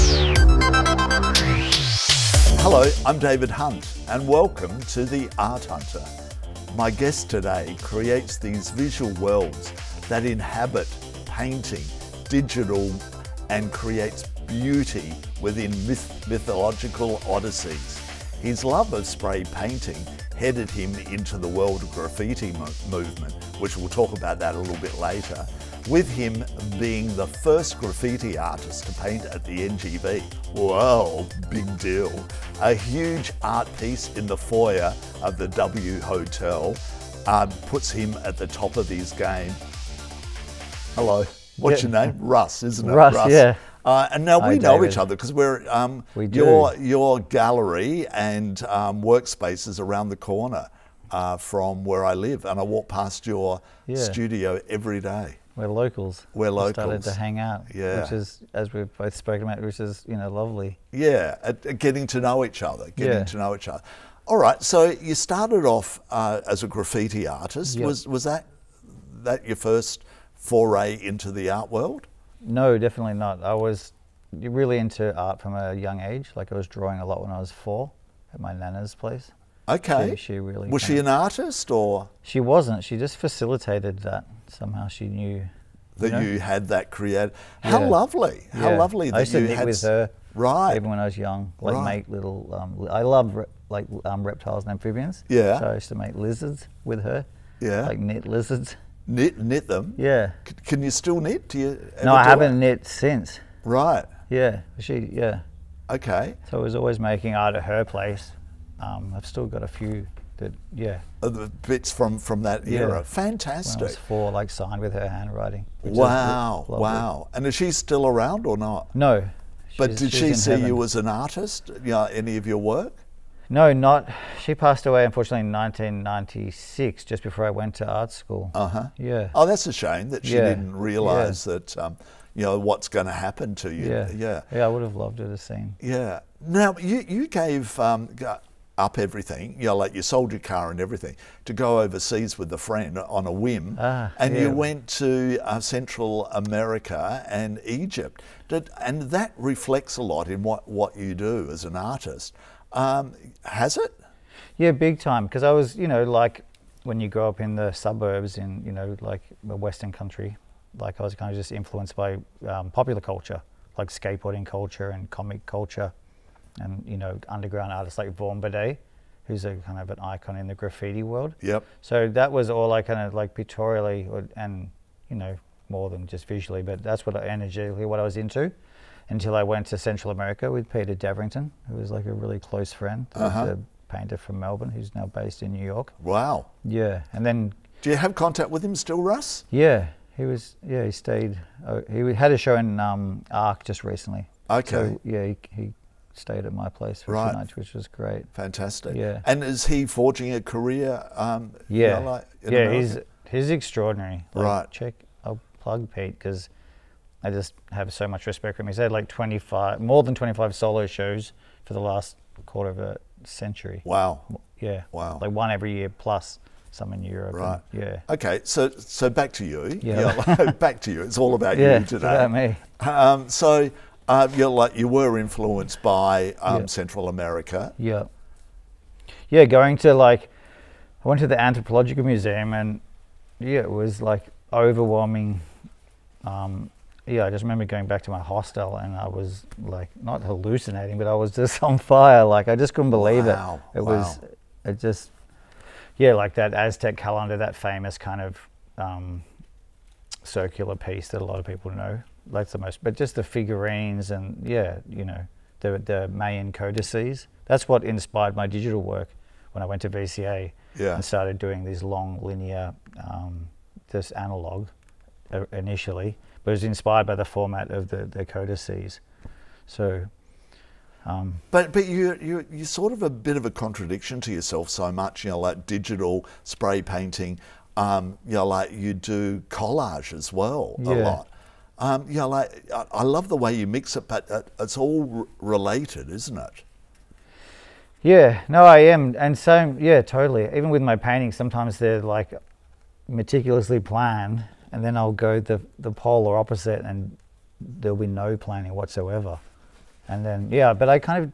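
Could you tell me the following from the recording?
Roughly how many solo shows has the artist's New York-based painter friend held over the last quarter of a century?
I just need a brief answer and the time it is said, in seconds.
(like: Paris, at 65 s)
More than 25, at 209 s.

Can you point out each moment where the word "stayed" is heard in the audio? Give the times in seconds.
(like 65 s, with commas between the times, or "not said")
190 s, 196 s.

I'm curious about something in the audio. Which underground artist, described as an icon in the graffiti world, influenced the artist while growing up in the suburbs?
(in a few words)
Vaughn Bodē.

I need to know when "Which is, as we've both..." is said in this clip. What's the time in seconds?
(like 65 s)
58 s.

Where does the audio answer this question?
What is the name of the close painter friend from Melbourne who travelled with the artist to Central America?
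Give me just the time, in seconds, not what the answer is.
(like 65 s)
180 s.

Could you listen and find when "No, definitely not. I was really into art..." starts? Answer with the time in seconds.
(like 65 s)
72 s.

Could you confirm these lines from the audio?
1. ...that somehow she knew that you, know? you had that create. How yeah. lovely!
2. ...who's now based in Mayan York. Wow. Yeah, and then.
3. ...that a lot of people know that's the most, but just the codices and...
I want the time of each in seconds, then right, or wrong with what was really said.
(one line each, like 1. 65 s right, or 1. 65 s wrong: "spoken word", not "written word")
1. 83 s right
2. 184 s wrong: "New", not "Mayan"
3. 251 s wrong: "figurines", not "codices".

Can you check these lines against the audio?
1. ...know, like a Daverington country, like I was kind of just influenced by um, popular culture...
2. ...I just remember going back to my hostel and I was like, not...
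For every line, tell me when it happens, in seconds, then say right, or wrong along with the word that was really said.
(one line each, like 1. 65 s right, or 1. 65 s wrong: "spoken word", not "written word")
1. 158 s wrong: "Western", not "Daverington"
2. 237 s right.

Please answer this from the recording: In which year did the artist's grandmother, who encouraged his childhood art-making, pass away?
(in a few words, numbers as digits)
1996.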